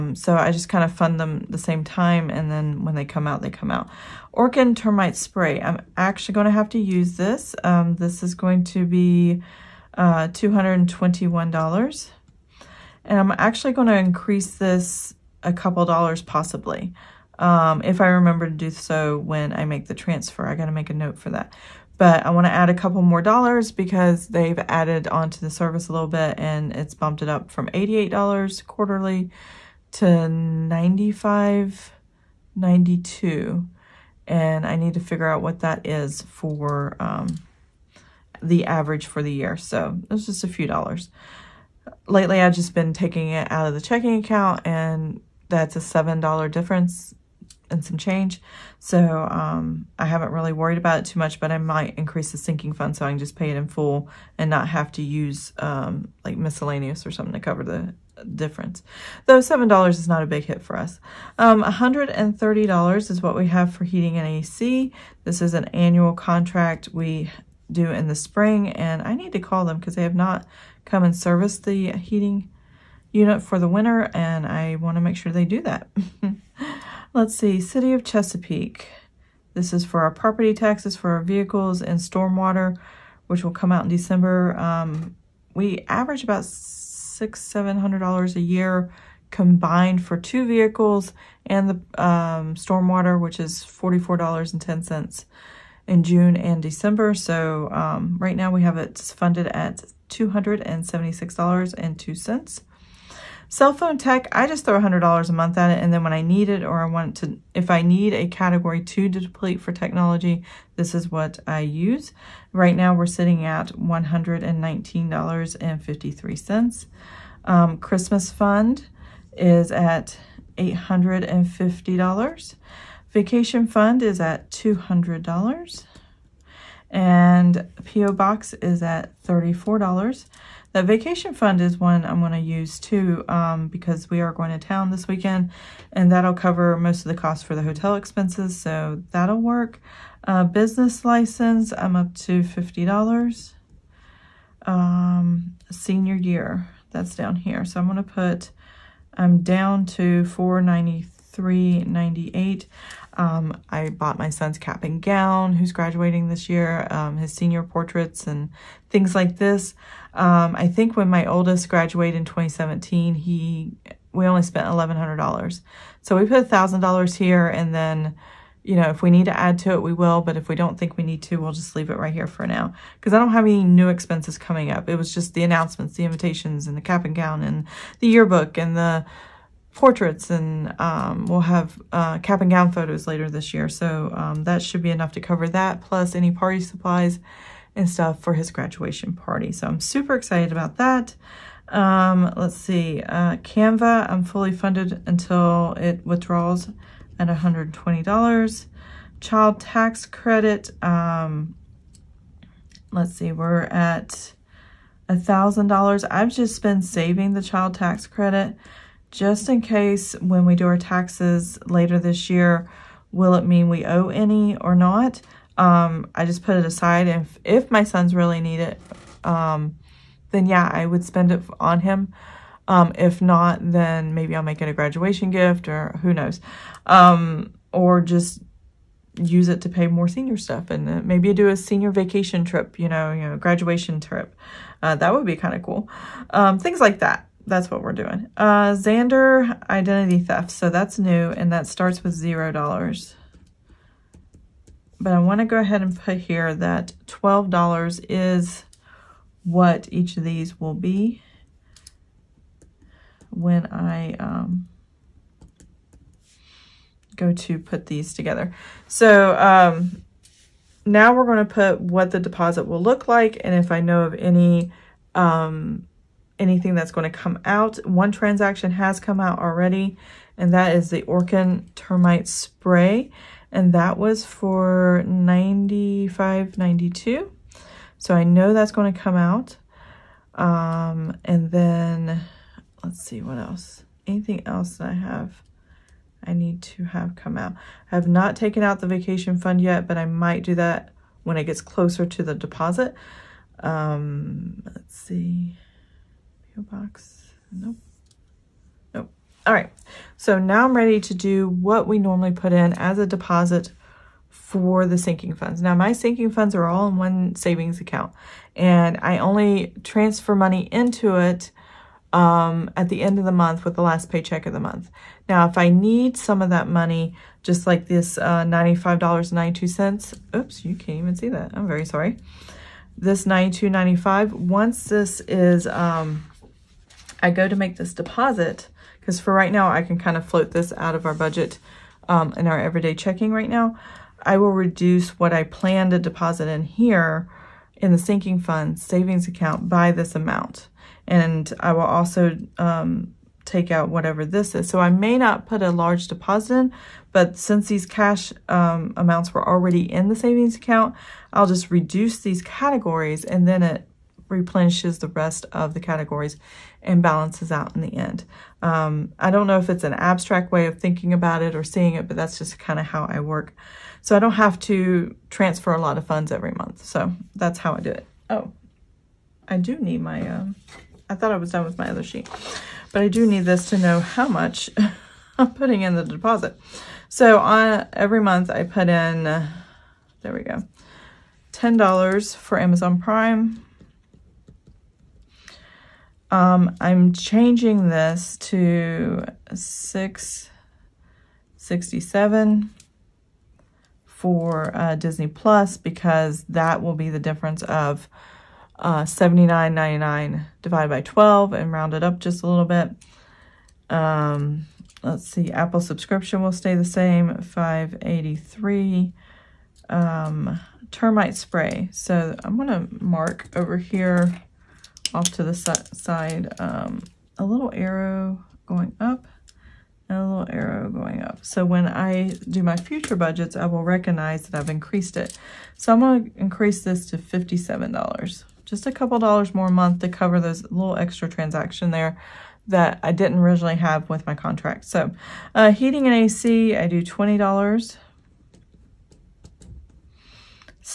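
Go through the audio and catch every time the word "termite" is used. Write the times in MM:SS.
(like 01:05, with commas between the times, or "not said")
00:04, 04:31, 06:50.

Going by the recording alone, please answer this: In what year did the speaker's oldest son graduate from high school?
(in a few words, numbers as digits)
2017.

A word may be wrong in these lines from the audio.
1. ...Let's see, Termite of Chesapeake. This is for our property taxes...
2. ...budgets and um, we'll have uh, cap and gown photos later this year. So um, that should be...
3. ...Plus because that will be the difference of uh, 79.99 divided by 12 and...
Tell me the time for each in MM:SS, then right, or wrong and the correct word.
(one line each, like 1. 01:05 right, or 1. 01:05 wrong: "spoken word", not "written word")
1. 01:17 wrong: "City", not "Termite"
2. 02:59 wrong: "portraits", not "budgets"
3. 06:35 right.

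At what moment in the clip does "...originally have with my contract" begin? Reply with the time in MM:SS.
07:13.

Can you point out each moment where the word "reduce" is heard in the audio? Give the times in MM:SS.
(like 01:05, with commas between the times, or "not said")
05:34, 05:51.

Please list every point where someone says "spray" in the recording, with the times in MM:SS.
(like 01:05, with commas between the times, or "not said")
00:05, 04:32, 06:51.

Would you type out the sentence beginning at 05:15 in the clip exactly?
Now, if I need some of that money, just like this uh, $95.92, oops, you can't even see that.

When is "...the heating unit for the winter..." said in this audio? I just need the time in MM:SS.
01:11.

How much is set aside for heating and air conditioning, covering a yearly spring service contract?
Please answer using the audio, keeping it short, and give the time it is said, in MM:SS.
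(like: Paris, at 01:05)
$130, at 01:01.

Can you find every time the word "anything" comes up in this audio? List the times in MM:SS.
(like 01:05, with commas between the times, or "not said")
04:26, 04:44.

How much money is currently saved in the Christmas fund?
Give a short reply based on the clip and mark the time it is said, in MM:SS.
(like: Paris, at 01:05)
$850, at 02:00.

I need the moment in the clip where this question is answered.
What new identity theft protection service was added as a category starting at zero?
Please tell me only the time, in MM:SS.
03:58.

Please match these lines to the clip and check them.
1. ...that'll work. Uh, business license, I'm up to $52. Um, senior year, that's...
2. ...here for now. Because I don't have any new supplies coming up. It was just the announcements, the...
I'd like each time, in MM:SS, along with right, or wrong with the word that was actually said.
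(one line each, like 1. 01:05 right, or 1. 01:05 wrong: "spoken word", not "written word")
1. 02:19 wrong: "50", not "52"
2. 02:52 wrong: "expenses", not "supplies".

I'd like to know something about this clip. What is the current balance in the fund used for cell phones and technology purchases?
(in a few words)
$119.53.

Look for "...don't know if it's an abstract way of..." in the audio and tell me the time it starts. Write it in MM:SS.
05:59.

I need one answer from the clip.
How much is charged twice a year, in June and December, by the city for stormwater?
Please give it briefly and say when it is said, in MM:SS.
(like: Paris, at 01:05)
$44.10, at 01:33.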